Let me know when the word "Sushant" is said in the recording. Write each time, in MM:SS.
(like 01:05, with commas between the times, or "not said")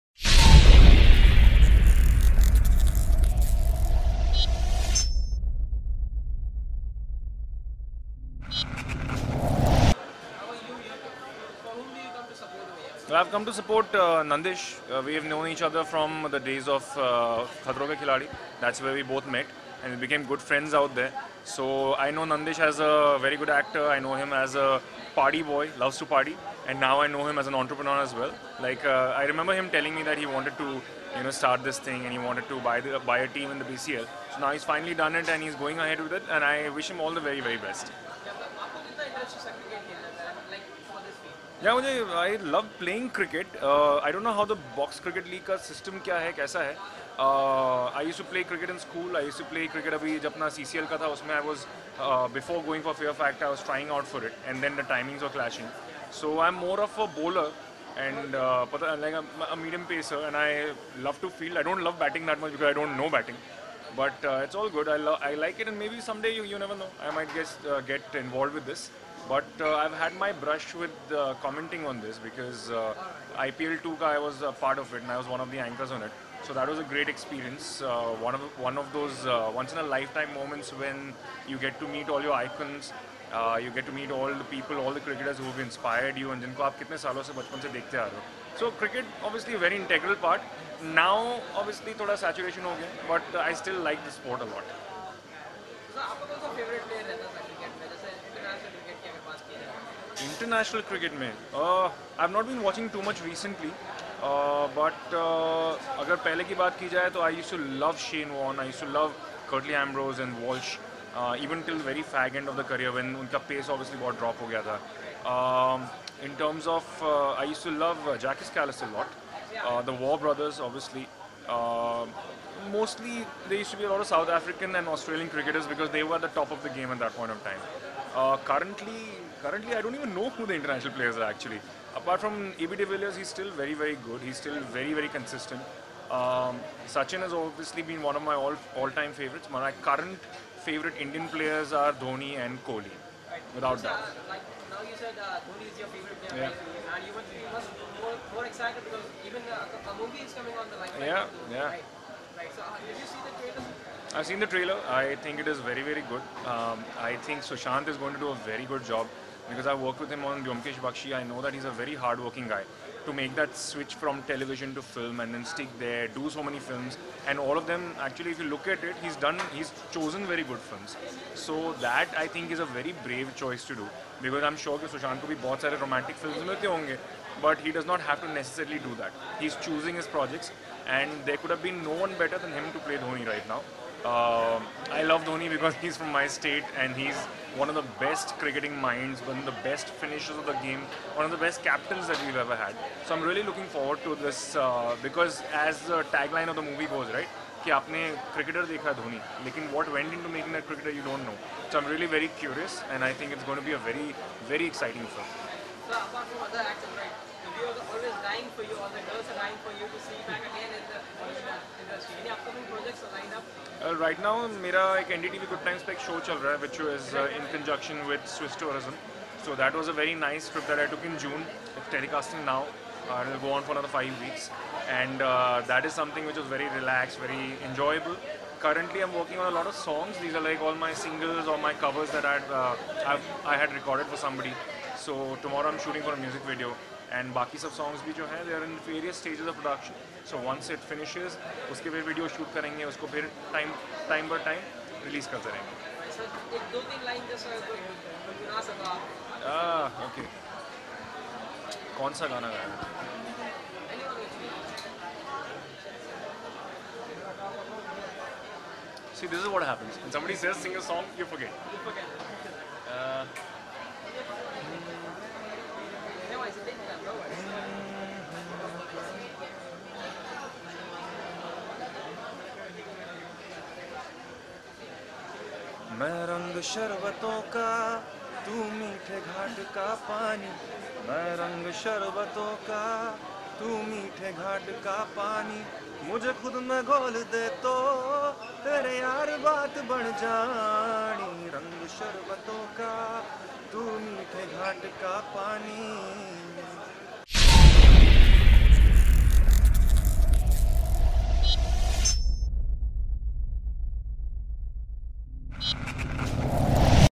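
02:37, 02:54.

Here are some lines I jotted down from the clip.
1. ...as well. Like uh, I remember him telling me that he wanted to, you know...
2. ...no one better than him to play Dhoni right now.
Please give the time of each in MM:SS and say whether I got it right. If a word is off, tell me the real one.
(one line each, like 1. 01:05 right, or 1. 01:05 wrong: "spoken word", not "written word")
1. 00:28 right
2. 03:01 right.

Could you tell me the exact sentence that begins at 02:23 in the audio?
Uh, like now you said uh, Dhoni is your favorite player, yeah.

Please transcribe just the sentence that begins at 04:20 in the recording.
When somebody says sing a song, you forget.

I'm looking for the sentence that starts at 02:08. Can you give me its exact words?
Uh, currently, currently I don't even know who the international players are actually.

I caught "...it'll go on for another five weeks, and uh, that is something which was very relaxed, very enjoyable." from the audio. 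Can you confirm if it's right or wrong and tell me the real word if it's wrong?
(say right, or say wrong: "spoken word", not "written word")
right.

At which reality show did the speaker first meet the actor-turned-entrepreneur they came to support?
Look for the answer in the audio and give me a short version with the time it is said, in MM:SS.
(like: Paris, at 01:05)
Khatron Ke Khiladi, at 00:17.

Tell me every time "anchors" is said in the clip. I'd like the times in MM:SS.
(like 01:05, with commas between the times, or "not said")
01:15.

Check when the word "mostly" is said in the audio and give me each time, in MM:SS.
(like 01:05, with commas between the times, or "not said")
02:02.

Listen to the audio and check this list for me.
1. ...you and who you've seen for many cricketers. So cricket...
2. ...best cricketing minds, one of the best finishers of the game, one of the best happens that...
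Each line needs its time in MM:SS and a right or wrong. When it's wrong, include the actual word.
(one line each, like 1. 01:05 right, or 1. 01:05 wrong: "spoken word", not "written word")
1. 01:26 wrong: "years", not "cricketers"
2. 03:07 wrong: "captains", not "happens".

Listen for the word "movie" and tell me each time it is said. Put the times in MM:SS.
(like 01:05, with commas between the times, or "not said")
02:30, 03:16.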